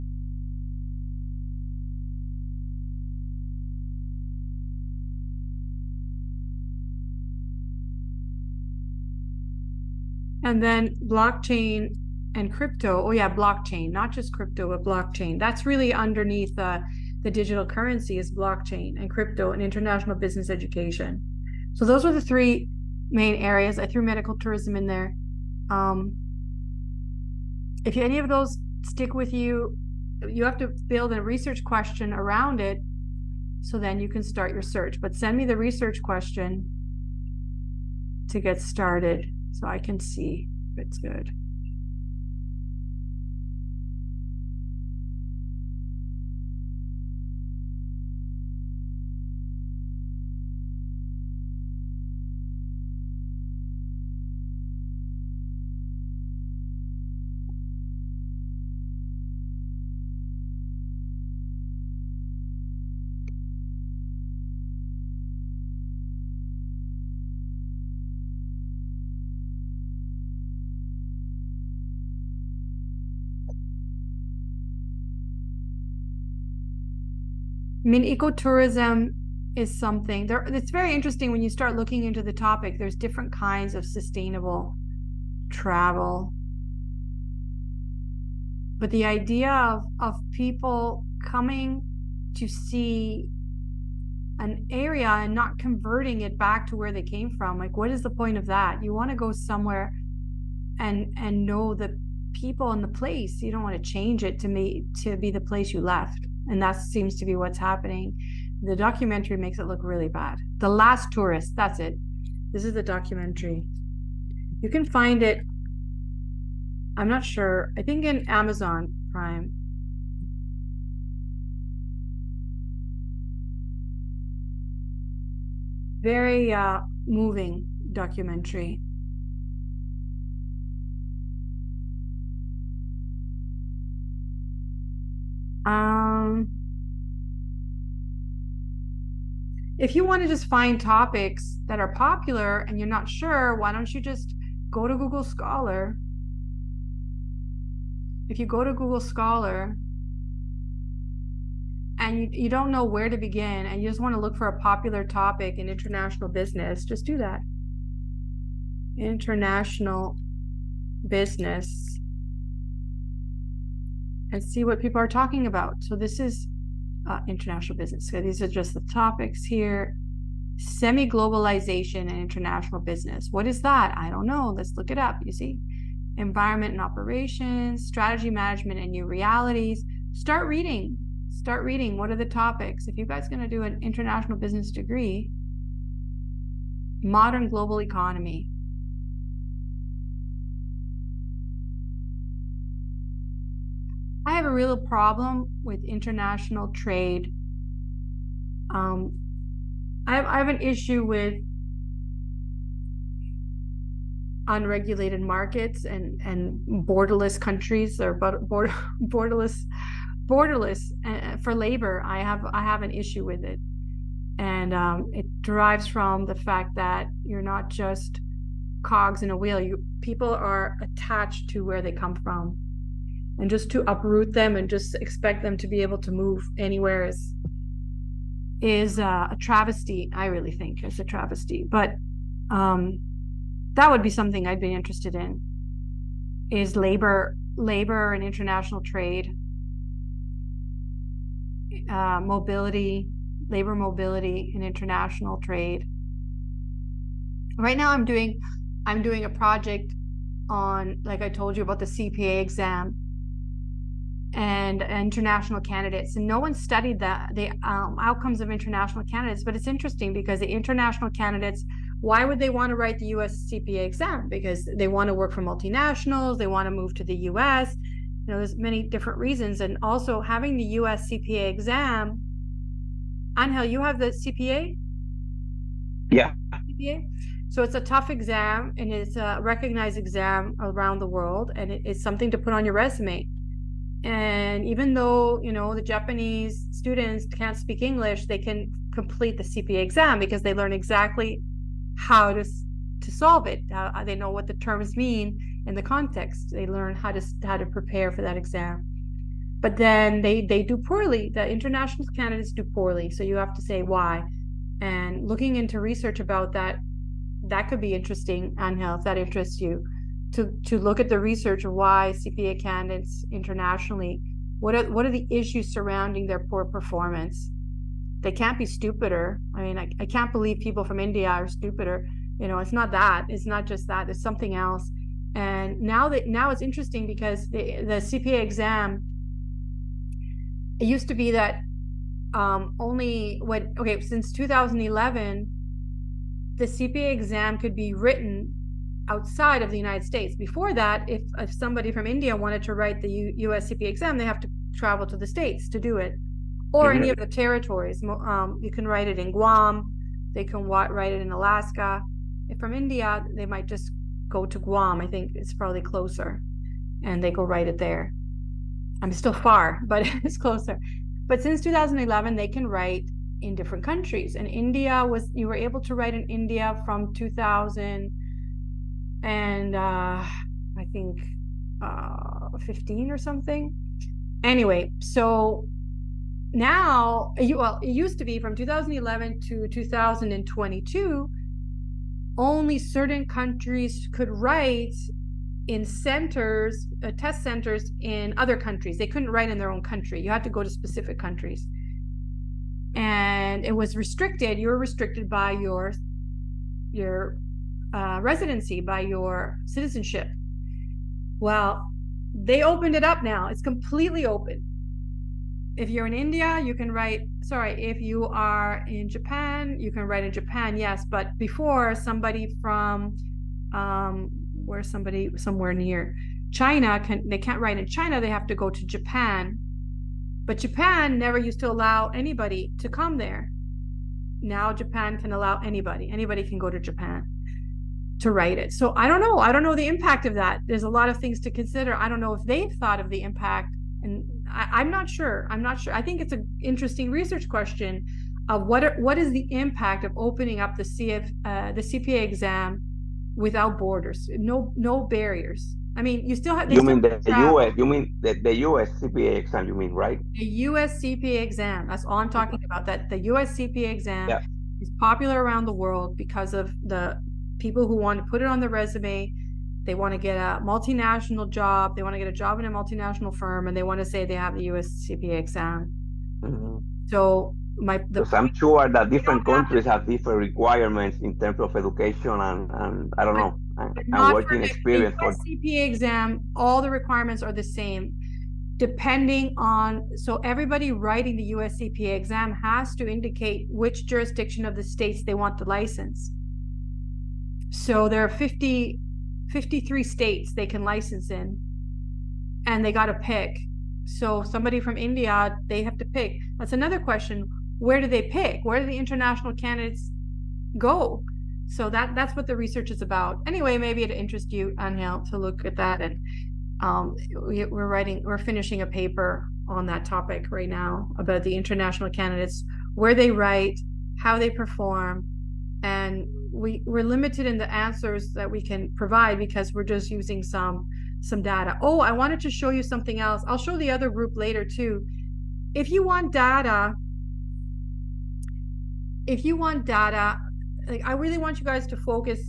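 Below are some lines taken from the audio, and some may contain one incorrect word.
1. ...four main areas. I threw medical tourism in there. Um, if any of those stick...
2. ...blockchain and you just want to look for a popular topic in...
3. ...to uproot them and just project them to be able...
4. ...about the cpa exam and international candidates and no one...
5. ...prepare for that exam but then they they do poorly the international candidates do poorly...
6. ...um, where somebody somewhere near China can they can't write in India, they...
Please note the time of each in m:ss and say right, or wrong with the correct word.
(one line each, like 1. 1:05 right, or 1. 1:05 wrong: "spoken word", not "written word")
1. 0:22 wrong: "three", not "four"
2. 2:33 wrong: "begin", not "blockchain"
3. 3:43 wrong: "expect", not "project"
4. 4:11 right
5. 4:57 right
6. 6:53 wrong: "China", not "India".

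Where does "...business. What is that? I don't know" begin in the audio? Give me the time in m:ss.
2:52.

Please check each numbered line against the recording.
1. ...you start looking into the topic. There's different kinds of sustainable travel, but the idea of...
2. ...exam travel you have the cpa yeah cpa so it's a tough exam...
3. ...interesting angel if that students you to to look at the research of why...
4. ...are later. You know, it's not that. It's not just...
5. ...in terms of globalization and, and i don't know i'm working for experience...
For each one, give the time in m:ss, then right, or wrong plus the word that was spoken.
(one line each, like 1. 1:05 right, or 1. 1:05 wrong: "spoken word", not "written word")
1. 1:21 right
2. 4:31 wrong: "angel", not "travel"
3. 5:07 wrong: "interests", not "students"
4. 5:21 wrong: "stupider", not "later"
5. 7:51 wrong: "education", not "globalization".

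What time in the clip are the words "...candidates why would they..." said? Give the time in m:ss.
4:21.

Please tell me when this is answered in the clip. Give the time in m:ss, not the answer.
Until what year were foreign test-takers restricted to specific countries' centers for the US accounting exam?
6:19.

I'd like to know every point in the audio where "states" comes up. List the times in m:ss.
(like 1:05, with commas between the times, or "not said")
5:40, 5:45, 8:04, 8:10.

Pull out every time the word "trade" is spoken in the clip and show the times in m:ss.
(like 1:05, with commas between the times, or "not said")
3:16, 3:58, 4:05.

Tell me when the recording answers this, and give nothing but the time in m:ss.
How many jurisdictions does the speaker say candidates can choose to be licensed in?
8:09.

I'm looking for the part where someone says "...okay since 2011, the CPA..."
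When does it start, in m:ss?
5:33.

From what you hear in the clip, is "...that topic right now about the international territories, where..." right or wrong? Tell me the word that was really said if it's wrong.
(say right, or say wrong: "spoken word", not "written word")
wrong: "candidates", not "territories".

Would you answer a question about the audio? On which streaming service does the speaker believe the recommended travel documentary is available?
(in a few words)
Amazon Prime.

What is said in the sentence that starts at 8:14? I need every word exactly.
So somebody from India, they have to pick.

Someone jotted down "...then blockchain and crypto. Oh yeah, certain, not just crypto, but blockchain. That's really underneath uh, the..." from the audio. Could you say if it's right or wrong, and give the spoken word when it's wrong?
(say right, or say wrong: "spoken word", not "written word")
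wrong: "blockchain", not "certain".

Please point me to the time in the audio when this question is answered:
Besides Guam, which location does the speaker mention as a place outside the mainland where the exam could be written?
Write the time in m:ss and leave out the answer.
5:51.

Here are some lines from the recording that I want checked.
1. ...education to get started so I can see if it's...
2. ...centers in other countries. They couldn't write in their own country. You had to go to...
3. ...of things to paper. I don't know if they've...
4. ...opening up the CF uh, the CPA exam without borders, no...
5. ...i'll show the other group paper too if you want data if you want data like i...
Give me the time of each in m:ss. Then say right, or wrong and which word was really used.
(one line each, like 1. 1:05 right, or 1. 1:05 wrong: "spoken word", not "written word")
1. 0:36 wrong: "question", not "education"
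2. 6:27 right
3. 7:11 wrong: "consider", not "paper"
4. 7:20 right
5. 8:43 wrong: "later", not "paper".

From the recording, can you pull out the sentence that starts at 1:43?
You don't want to change it to me to be the place you left.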